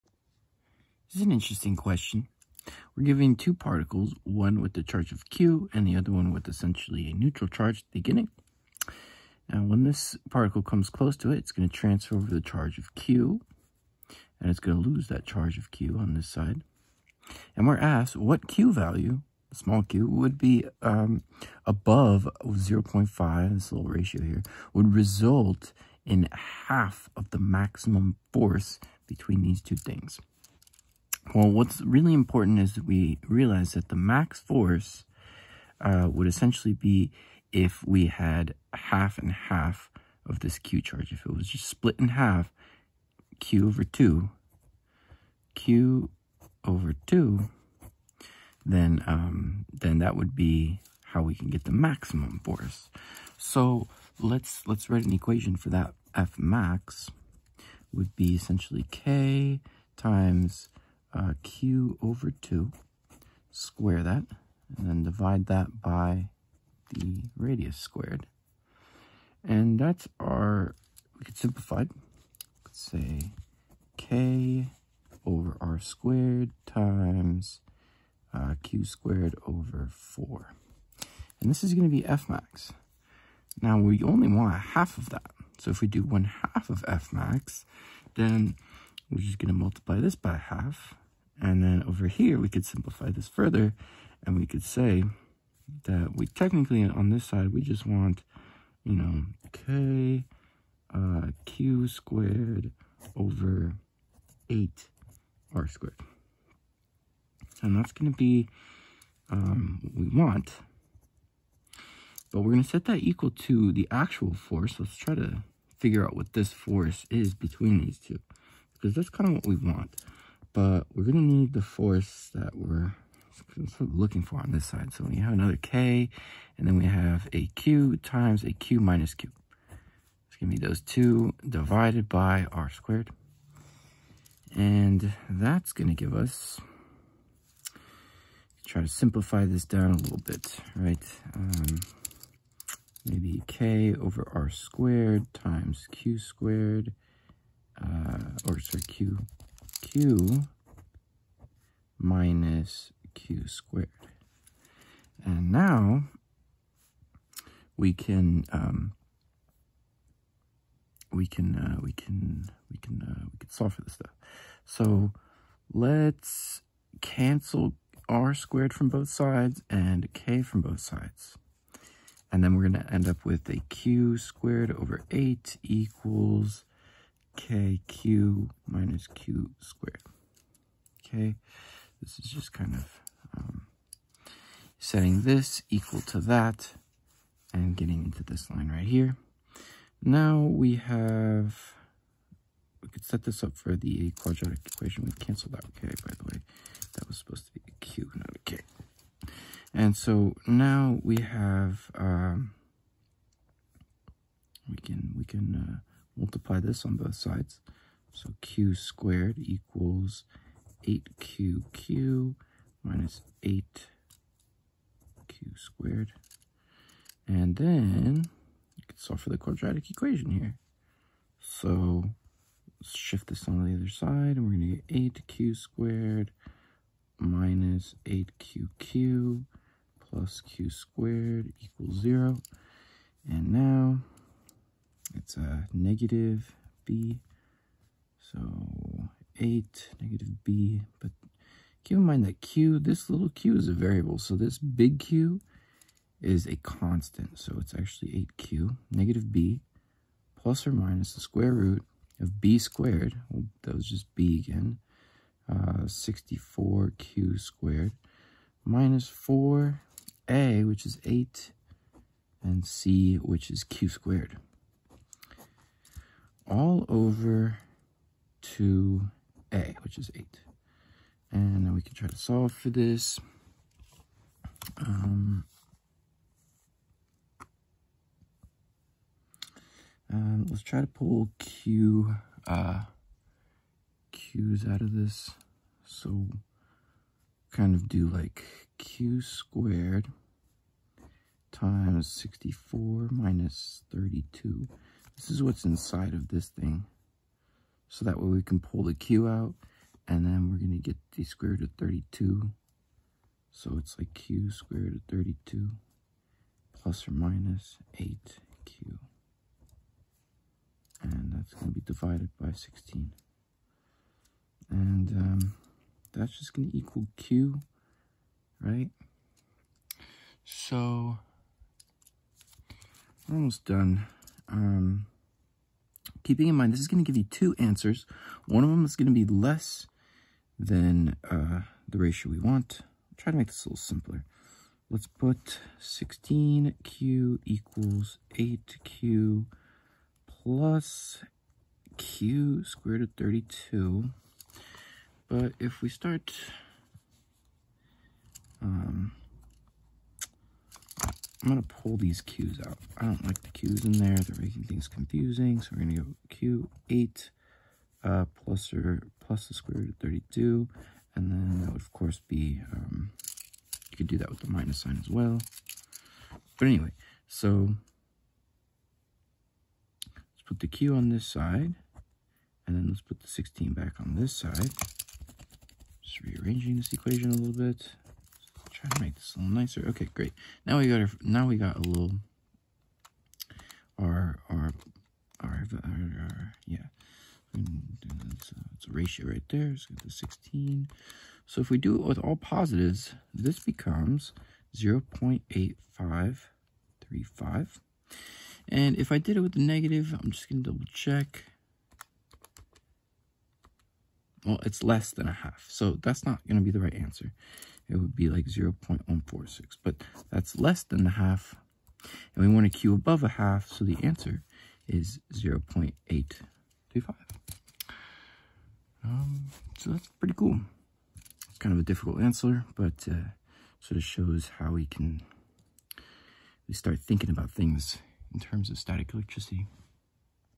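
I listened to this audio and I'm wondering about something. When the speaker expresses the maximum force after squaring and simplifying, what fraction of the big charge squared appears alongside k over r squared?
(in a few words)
Q squared over 4.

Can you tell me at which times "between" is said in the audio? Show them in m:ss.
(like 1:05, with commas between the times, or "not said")
0:29, 1:57.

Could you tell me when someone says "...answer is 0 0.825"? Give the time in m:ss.
6:54.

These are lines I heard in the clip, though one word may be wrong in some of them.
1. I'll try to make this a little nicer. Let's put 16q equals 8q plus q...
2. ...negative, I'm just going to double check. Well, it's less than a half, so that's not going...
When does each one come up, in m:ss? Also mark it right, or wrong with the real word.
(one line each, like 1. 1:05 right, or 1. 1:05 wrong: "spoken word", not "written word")
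1. 5:32 wrong: "simpler", not "nicer"
2. 6:39 right.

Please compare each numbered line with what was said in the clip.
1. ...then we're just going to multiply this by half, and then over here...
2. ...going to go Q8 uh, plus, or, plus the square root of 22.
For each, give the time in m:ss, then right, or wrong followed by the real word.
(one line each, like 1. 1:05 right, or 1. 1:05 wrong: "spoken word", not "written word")
1. 1:28 right
2. 5:55 wrong: "32", not "22".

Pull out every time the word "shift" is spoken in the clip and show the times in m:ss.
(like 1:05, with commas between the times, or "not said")
3:42.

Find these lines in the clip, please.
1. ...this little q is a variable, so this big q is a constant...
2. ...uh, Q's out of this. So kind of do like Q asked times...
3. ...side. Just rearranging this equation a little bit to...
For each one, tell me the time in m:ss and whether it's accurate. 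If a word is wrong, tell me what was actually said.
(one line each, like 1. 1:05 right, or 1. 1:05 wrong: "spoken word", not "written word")
1. 4:02 right
2. 4:42 wrong: "squared", not "asked"
3. 6:14 right.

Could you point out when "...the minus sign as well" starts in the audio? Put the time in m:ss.
6:04.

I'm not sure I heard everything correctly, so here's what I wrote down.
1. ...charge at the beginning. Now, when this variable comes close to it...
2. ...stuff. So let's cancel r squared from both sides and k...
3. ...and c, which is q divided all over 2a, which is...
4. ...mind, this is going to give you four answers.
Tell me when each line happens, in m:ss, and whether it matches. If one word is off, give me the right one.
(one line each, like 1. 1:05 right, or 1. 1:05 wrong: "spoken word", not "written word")
1. 0:07 wrong: "particle", not "variable"
2. 2:43 right
3. 4:22 wrong: "squared", not "divided"
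4. 5:26 wrong: "two", not "four".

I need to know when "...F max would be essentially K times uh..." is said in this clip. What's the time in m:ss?
0:56.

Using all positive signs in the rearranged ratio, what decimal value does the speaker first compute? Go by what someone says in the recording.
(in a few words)
0.8535.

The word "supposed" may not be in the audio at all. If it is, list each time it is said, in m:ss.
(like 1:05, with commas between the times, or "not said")
3:17.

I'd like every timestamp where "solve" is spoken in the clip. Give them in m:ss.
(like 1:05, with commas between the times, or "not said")
2:43, 3:38, 4:32.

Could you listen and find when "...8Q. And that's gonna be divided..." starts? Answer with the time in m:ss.
5:07.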